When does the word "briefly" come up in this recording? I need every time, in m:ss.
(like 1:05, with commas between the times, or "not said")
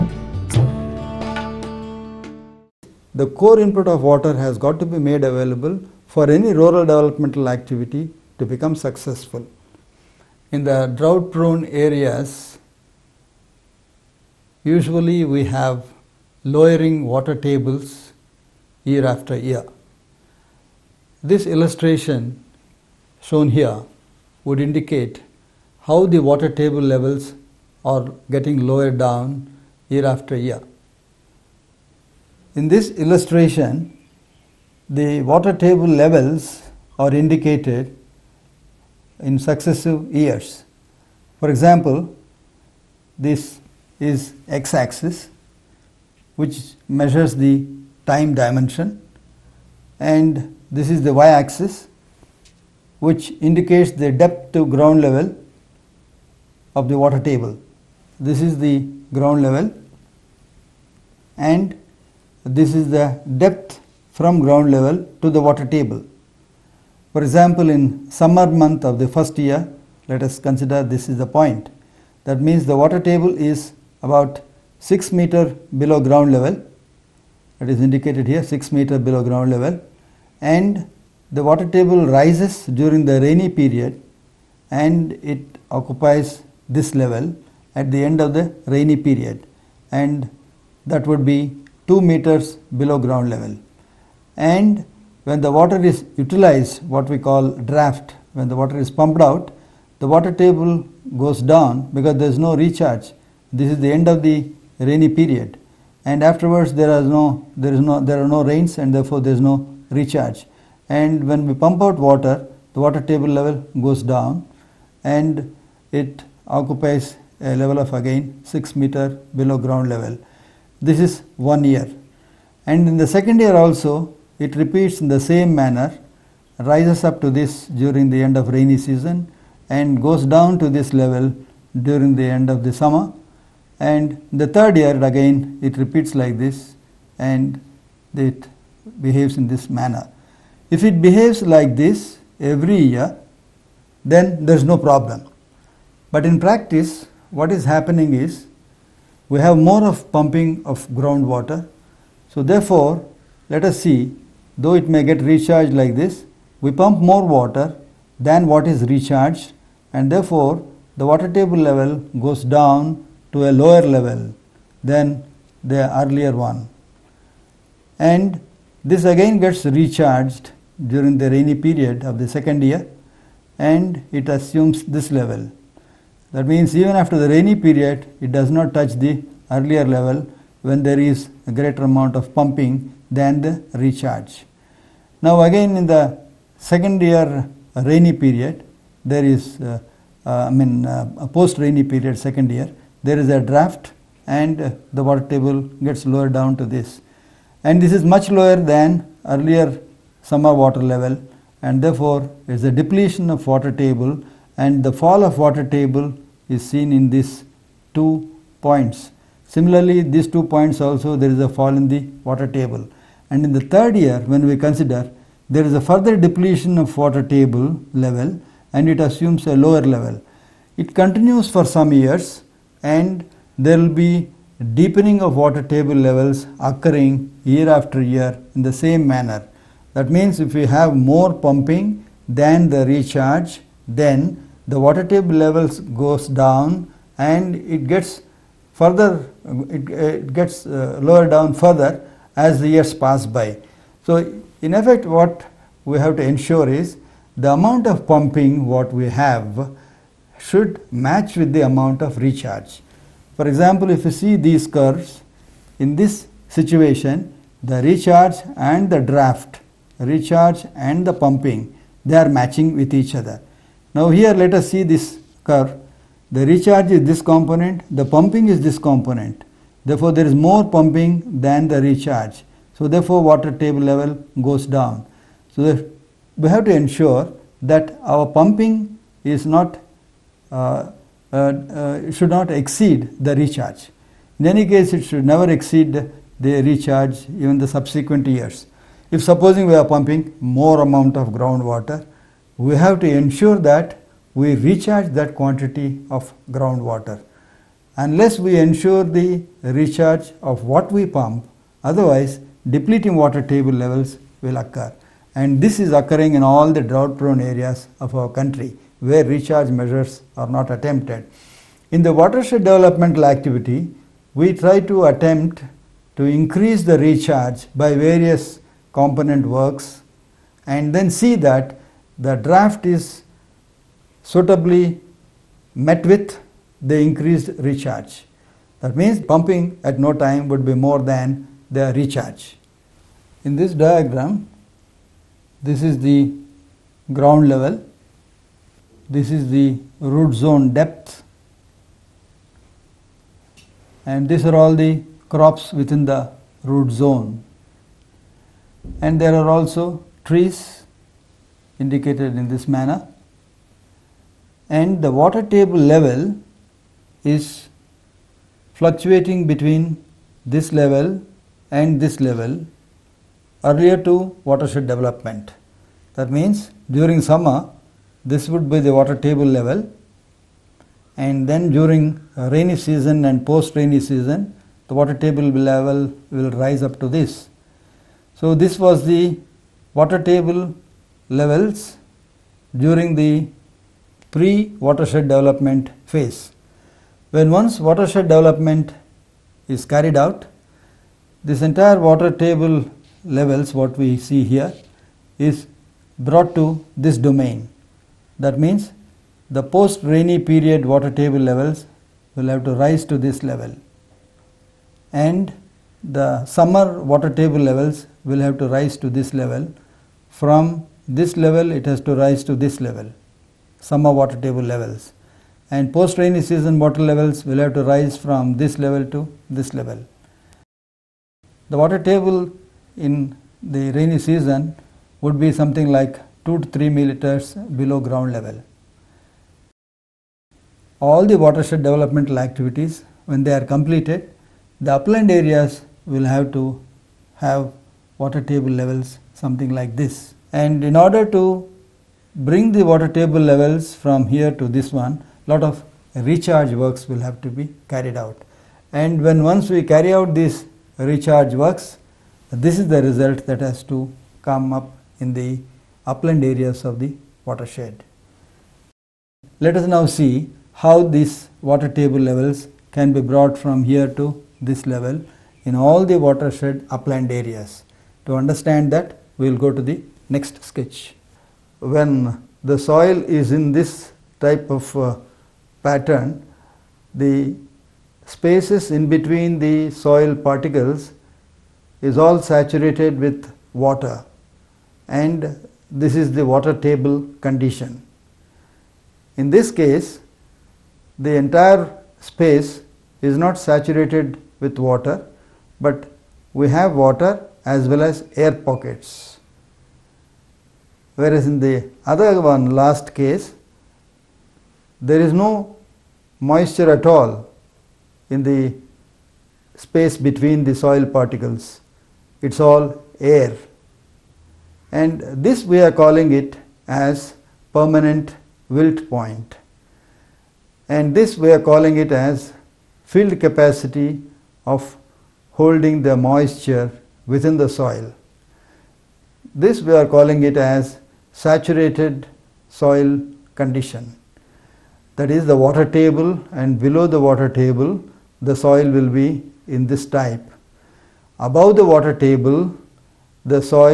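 not said.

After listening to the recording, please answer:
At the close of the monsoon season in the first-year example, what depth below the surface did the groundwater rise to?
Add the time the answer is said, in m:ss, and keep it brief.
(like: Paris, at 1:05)
2 meters, at 1:31.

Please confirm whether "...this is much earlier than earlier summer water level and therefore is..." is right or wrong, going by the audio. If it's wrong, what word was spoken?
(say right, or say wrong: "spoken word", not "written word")
wrong: "lower", not "earlier".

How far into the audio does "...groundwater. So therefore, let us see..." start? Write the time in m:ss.
2:30.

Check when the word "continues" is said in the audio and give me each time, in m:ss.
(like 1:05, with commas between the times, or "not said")
3:40.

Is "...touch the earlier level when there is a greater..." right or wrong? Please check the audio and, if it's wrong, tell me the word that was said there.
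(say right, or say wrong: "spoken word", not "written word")
right.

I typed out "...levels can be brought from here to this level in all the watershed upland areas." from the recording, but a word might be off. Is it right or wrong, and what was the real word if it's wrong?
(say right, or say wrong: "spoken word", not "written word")
right.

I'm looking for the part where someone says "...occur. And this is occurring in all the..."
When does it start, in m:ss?
5:04.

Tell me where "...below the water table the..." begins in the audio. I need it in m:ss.
8:56.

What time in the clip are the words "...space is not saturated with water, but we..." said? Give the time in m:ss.
8:12.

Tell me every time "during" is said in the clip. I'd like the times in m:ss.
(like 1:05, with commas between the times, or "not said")
1:22, 2:07, 2:11, 2:50, 6:06, 6:11, 6:22.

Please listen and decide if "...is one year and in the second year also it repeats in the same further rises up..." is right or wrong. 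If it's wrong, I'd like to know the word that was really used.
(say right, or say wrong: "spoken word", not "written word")
wrong: "manner", not "further".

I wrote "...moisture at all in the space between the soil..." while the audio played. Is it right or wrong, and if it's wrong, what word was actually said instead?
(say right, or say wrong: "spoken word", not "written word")
right.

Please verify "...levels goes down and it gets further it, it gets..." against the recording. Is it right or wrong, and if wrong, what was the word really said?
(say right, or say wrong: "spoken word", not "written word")
right.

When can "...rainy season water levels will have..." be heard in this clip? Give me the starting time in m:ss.
6:56.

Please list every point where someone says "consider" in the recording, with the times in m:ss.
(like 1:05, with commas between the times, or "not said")
1:10, 3:34.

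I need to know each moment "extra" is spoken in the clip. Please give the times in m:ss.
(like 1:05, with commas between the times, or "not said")
not said.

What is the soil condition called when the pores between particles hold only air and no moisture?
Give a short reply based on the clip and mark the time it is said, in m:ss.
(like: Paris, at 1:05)
permanent wilt point, at 8:37.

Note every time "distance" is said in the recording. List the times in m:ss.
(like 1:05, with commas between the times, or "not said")
not said.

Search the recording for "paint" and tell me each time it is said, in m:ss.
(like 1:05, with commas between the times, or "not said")
not said.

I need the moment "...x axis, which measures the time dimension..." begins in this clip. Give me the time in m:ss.
0:44.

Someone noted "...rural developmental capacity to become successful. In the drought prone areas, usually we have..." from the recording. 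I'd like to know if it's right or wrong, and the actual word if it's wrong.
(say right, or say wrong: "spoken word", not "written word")
wrong: "activity", not "capacity".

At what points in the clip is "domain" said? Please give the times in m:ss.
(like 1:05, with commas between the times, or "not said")
6:37.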